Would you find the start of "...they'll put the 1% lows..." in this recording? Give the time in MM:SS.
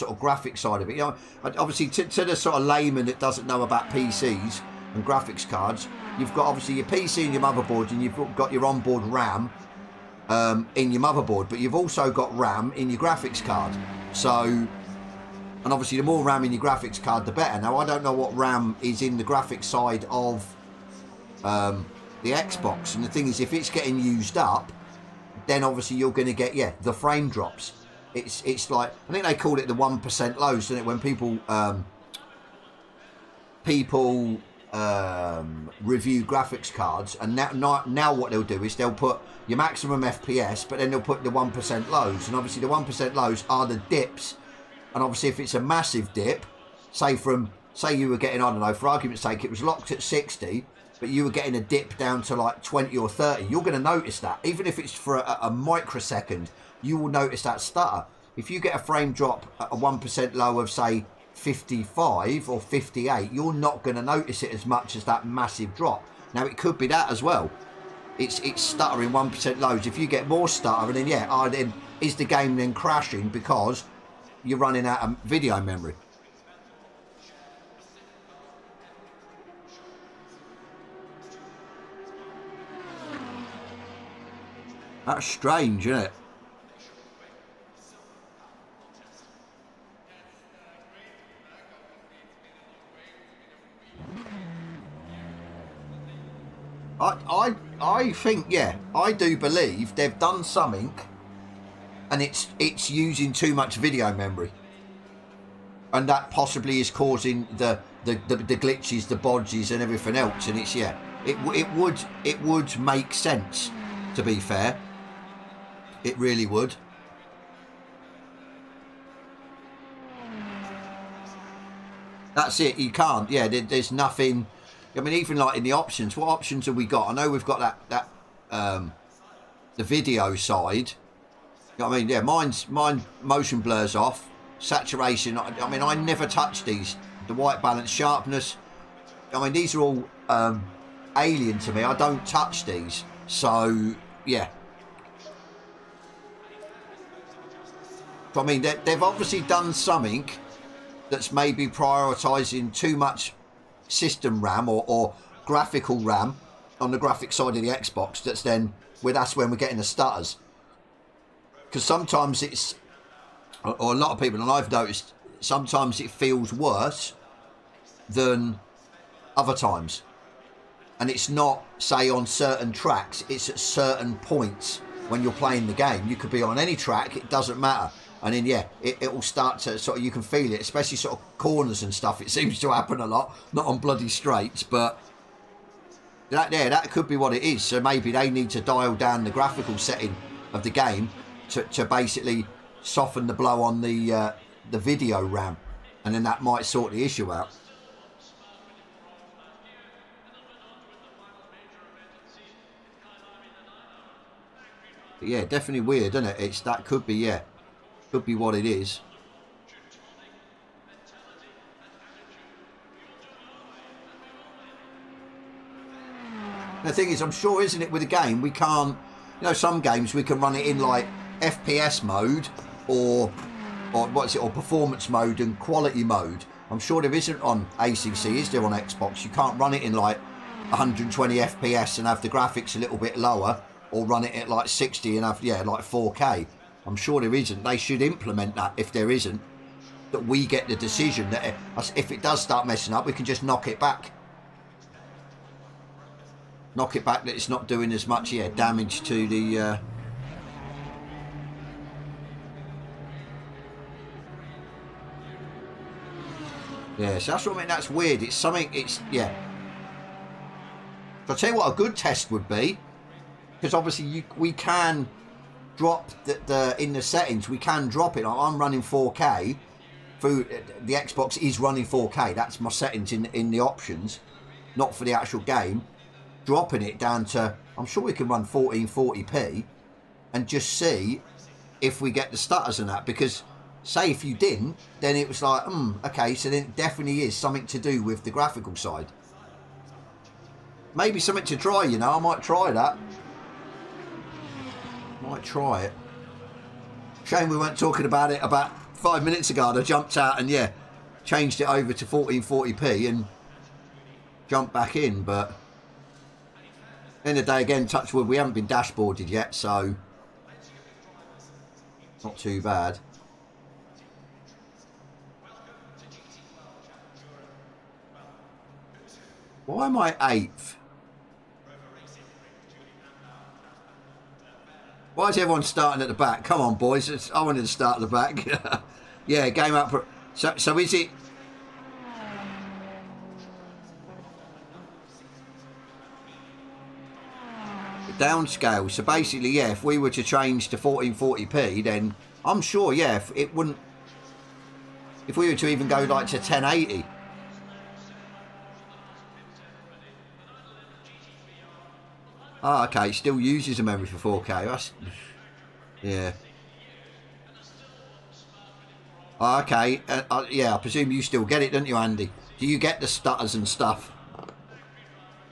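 00:40.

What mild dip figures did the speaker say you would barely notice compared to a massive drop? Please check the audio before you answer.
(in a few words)
55 or 58.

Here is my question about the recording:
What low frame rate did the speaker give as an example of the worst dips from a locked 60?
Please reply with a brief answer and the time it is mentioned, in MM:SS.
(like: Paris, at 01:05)
20 or 30, at 00:52.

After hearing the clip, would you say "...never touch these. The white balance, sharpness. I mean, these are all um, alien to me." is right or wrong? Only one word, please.
right.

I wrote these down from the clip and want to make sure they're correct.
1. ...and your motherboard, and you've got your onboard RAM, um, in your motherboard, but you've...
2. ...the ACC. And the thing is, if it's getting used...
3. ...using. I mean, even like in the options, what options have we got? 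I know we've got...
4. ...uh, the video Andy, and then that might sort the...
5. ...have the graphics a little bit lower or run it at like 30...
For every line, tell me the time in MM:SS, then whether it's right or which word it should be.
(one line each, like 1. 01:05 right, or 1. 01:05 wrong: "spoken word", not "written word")
1. 00:07 right
2. 00:22 wrong: "Xbox", not "ACC"
3. 02:03 wrong: "nothing", not "using"
4. 03:14 wrong: "RAM", not "Andy"
5. 03:52 wrong: "60", not "30".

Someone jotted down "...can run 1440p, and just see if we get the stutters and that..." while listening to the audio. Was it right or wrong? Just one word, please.
right.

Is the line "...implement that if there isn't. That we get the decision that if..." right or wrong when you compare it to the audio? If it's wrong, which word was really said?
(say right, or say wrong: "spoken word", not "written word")
right.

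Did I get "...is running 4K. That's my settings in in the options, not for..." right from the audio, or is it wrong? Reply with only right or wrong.
right.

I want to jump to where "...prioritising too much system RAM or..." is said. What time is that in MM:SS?
02:31.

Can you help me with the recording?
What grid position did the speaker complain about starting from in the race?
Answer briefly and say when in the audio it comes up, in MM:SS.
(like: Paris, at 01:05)
eighth, at 05:20.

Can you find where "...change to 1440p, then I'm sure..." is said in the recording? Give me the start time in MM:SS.
05:40.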